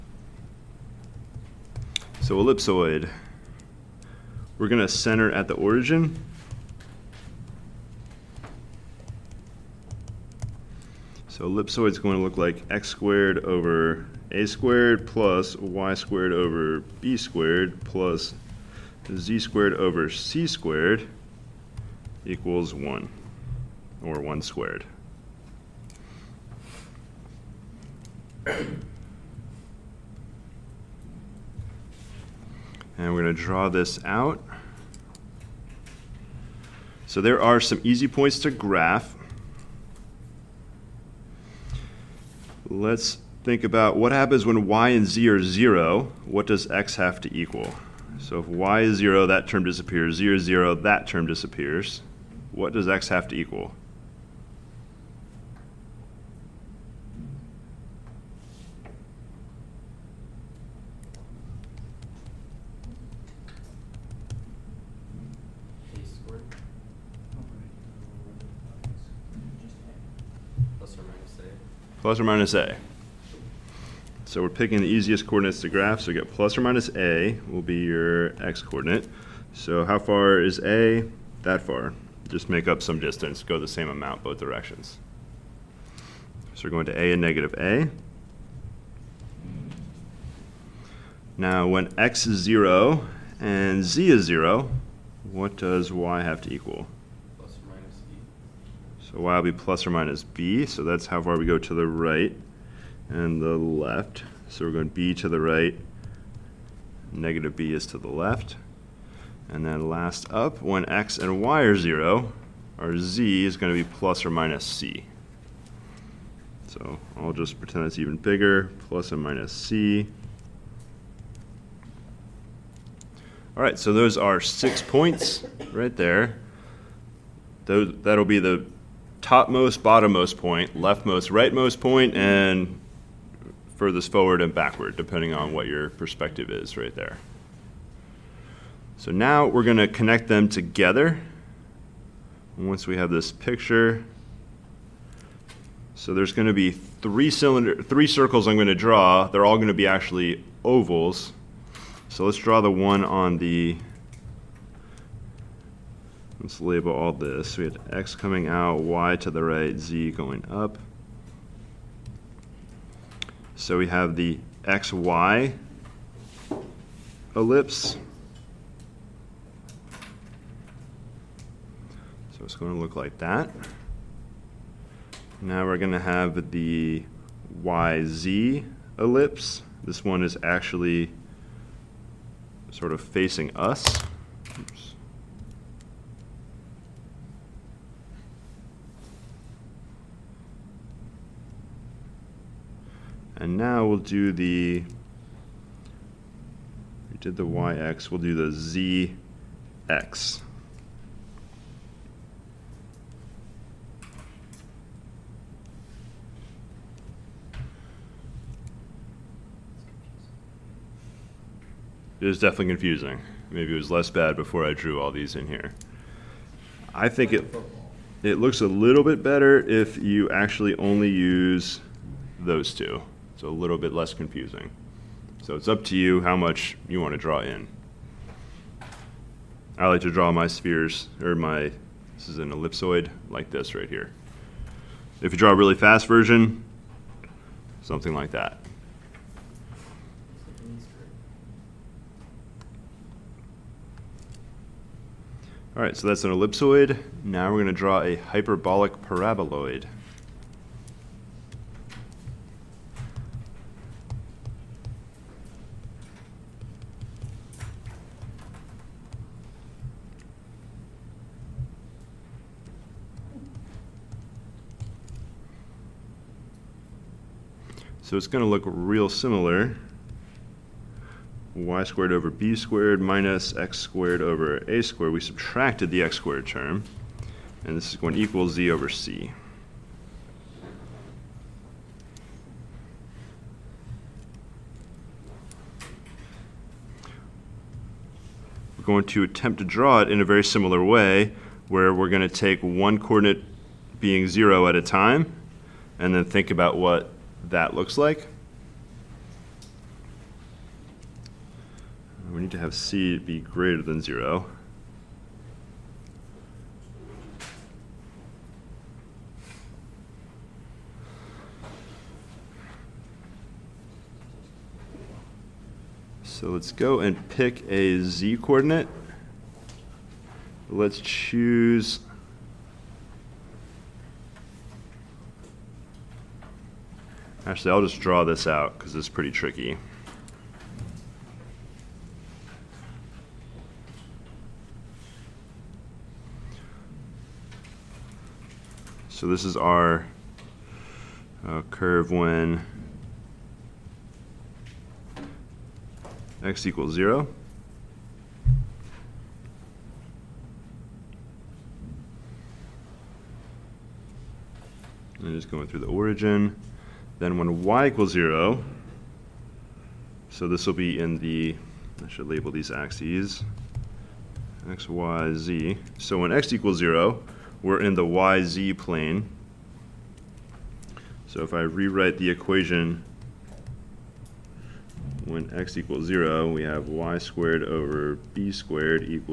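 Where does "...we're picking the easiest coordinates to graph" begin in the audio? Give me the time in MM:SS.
01:14.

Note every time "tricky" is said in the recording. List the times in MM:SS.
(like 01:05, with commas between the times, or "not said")
05:29.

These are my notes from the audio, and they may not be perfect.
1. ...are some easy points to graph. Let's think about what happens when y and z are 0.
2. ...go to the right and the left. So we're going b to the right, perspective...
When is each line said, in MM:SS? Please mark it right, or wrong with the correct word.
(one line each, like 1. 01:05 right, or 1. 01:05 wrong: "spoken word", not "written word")
1. 00:37 right
2. 01:41 wrong: "negative", not "perspective".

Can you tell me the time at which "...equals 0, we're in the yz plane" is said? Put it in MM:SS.
06:06.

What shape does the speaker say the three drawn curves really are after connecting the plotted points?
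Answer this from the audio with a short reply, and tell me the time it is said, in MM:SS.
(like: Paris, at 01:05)
ovals, at 02:30.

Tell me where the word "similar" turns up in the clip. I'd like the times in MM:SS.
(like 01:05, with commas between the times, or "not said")
04:29, 04:50.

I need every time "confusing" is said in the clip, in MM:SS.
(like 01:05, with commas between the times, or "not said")
03:32, 03:44.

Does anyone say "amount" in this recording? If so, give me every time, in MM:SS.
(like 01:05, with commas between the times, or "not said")
01:23.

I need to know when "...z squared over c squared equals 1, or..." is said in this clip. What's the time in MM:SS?
00:19.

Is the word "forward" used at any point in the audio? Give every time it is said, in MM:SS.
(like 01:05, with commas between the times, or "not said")
02:14.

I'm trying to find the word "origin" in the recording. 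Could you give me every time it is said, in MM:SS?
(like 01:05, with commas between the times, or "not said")
00:05, 05:55.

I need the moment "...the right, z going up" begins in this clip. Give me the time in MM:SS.
02:39.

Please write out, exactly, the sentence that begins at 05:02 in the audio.
We need to have C be greater than zero.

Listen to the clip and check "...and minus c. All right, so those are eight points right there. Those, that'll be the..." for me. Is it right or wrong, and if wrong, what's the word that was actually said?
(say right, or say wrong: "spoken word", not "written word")
wrong: "six", not "eight".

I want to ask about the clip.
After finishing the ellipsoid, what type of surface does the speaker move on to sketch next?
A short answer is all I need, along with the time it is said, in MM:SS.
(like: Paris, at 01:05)
hyperbolic paraboloid, at 04:08.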